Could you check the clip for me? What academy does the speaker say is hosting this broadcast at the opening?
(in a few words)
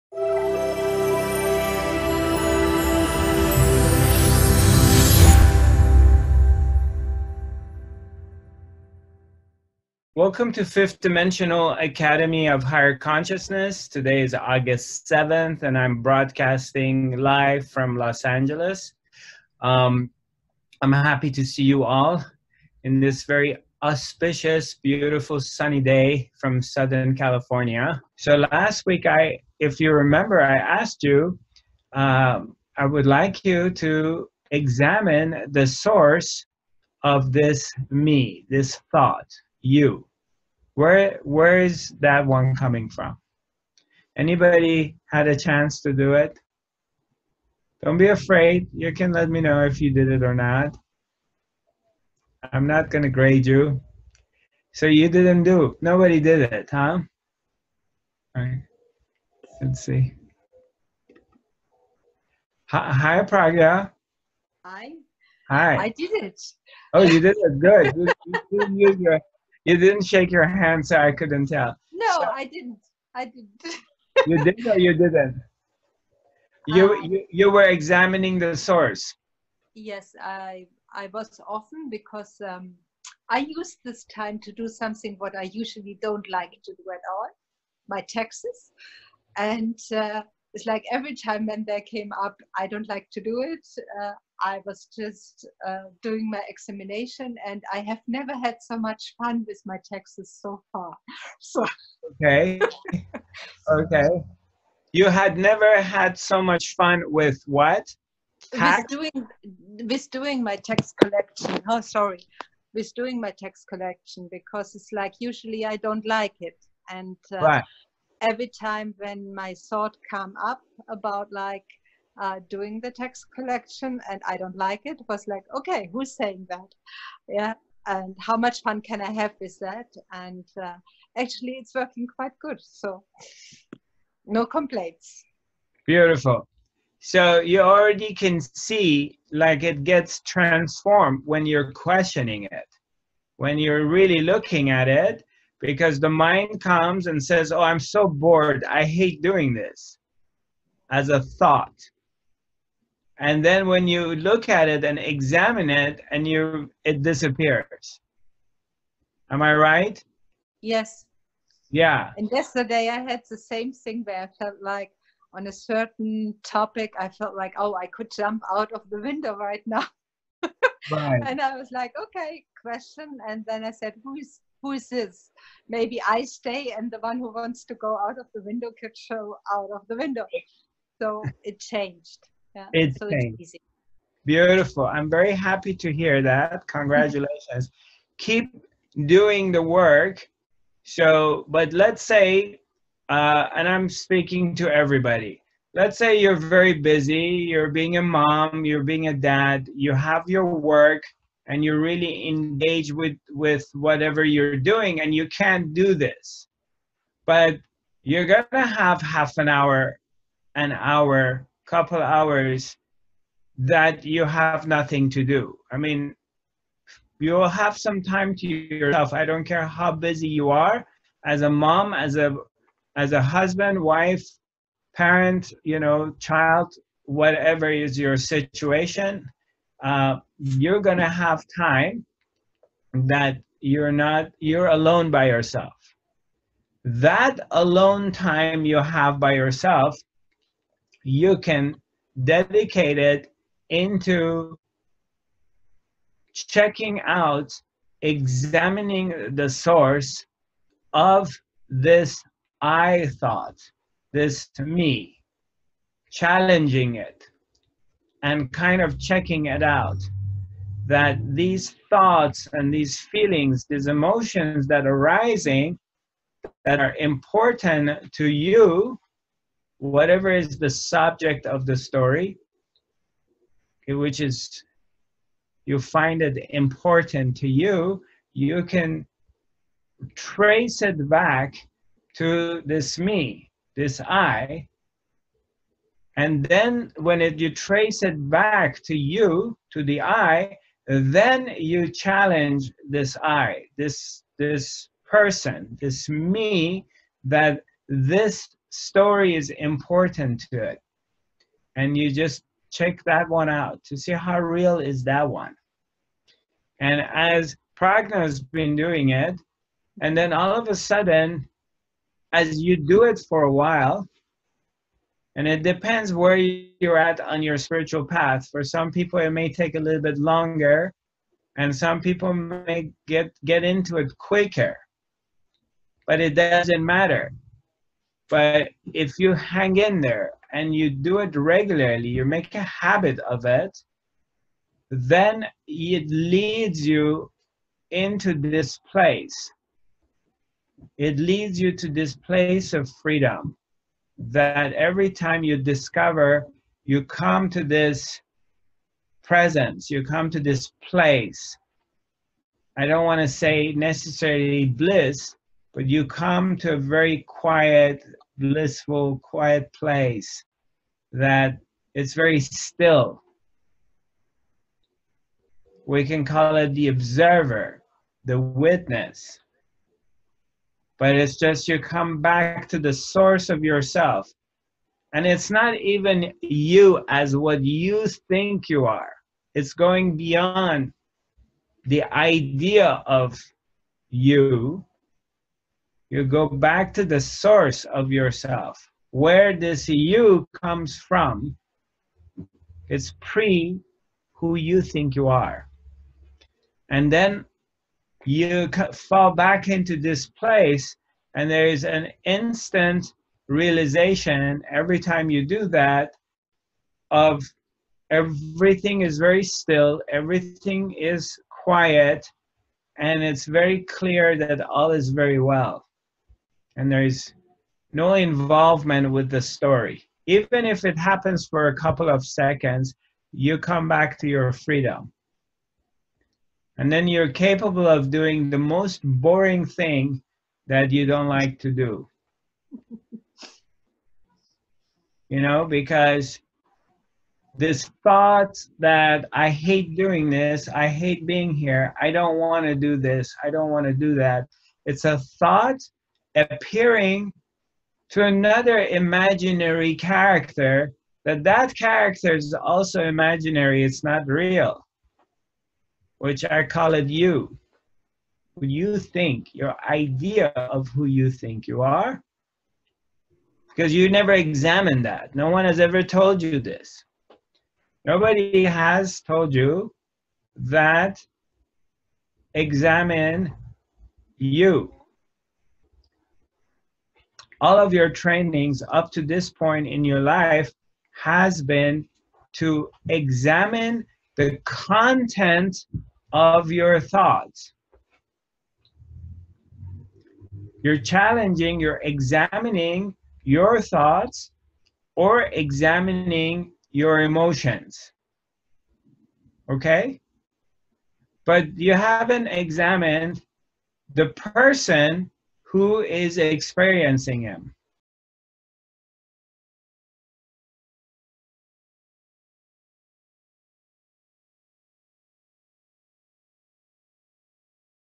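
Fifth Dimensional Academy of Higher Consciousness.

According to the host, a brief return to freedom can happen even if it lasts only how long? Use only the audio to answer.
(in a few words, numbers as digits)
A couple of seconds.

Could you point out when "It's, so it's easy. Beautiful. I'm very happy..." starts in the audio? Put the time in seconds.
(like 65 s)
182 s.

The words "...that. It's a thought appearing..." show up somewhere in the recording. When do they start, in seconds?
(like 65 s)
444 s.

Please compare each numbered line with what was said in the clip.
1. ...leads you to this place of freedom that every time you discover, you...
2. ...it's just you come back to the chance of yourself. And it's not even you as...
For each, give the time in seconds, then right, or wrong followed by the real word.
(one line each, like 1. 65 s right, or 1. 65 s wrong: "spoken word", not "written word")
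1. 341 s right
2. 371 s wrong: "source", not "chance".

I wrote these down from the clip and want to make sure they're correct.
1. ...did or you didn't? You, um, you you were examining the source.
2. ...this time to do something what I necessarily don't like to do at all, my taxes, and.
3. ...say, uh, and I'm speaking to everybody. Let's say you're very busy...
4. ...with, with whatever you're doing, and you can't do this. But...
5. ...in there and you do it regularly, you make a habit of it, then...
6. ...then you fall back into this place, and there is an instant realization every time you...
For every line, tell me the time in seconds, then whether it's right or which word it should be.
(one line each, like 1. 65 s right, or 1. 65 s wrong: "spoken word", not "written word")
1. 74 s right
2. 83 s wrong: "usually", not "necessarily"
3. 192 s right
4. 202 s right
5. 329 s right
6. 397 s right.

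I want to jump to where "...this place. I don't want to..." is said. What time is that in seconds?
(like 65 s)
350 s.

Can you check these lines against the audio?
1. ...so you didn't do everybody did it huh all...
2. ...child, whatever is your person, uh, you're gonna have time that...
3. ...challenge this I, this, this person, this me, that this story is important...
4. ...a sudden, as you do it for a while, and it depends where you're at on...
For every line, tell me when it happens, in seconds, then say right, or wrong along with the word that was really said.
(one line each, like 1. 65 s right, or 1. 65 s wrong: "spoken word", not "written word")
1. 54 s wrong: "nobody", not "everybody"
2. 226 s wrong: "situation", not "person"
3. 291 s right
4. 310 s right.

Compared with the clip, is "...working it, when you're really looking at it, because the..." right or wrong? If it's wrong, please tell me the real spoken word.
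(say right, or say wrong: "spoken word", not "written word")
wrong: "questioning", not "working".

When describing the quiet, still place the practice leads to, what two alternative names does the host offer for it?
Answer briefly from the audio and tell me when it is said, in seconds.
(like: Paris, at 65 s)
The observer, the witness, at 366 s.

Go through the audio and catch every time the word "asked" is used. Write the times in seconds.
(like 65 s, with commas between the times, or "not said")
30 s.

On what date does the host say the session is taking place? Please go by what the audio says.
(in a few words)
August 7th.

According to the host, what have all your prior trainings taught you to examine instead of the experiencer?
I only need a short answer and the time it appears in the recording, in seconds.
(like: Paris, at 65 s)
The content of your thoughts, at 484 s.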